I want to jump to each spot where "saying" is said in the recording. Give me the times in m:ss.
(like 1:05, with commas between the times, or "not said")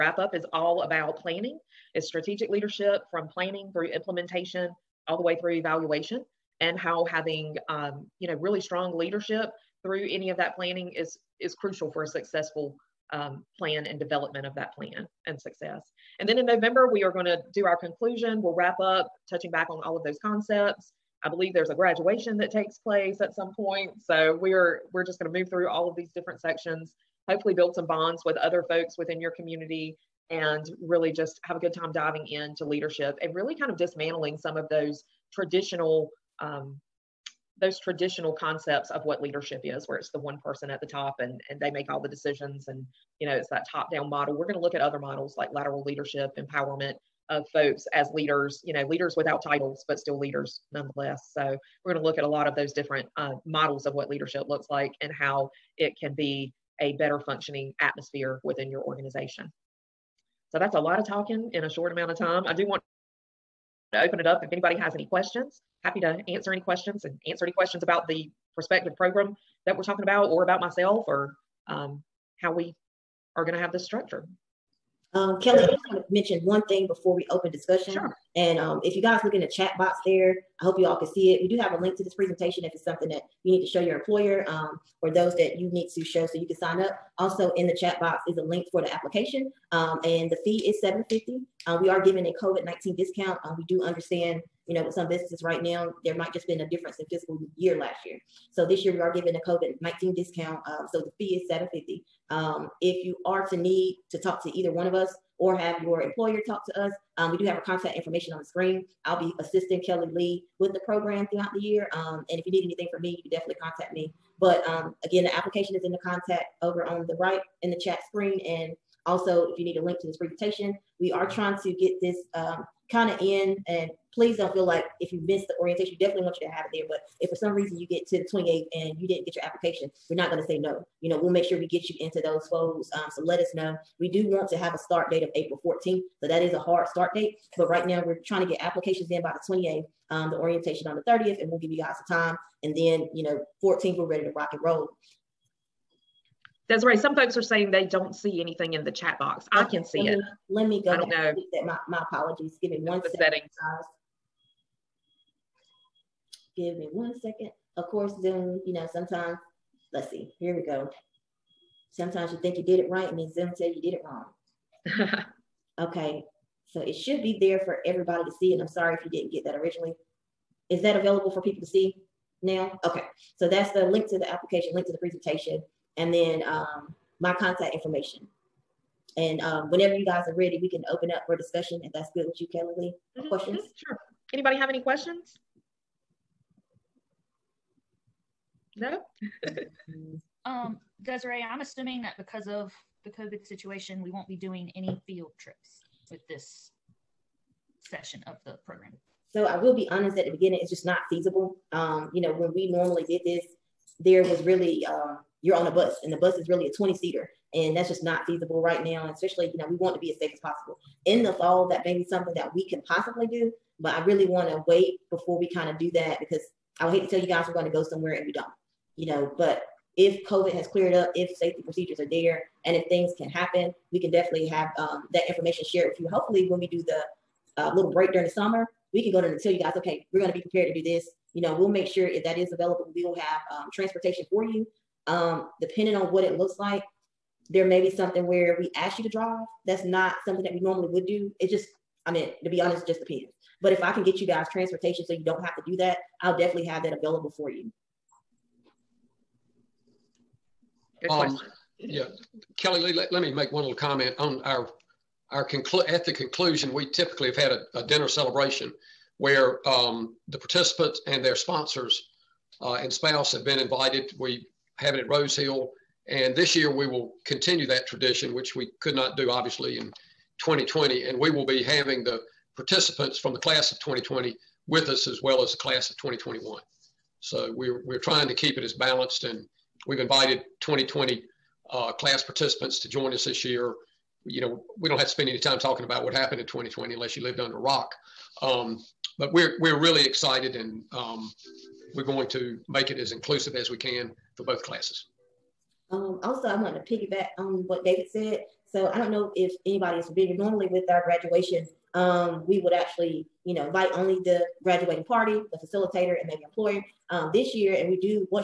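2:27.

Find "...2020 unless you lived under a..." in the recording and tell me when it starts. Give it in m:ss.
4:46.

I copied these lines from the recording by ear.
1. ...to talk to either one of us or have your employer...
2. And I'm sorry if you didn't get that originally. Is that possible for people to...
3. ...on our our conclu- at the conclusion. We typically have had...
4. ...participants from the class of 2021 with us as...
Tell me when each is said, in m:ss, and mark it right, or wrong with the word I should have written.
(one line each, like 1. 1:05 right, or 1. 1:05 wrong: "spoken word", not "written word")
1. 1:44 right
2. 2:48 wrong: "available", not "possible"
3. 4:14 right
4. 4:32 wrong: "2020", not "2021".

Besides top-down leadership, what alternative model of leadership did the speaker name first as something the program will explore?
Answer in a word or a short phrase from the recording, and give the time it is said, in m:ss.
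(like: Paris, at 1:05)
lateral leadership, at 0:45.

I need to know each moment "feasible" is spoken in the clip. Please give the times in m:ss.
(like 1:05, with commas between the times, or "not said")
3:21, 3:28.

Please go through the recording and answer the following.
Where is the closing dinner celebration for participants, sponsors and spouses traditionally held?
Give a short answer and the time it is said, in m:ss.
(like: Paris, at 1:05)
Rose Hill, at 4:25.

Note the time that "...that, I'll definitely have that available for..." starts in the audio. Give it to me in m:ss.
4:05.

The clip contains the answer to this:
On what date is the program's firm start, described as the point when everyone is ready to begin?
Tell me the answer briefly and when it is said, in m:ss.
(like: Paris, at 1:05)
April 14th, at 2:15.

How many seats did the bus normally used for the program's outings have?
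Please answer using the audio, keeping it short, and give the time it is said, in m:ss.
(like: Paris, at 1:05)
20, at 3:26.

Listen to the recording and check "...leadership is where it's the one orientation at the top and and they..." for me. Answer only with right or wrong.
wrong.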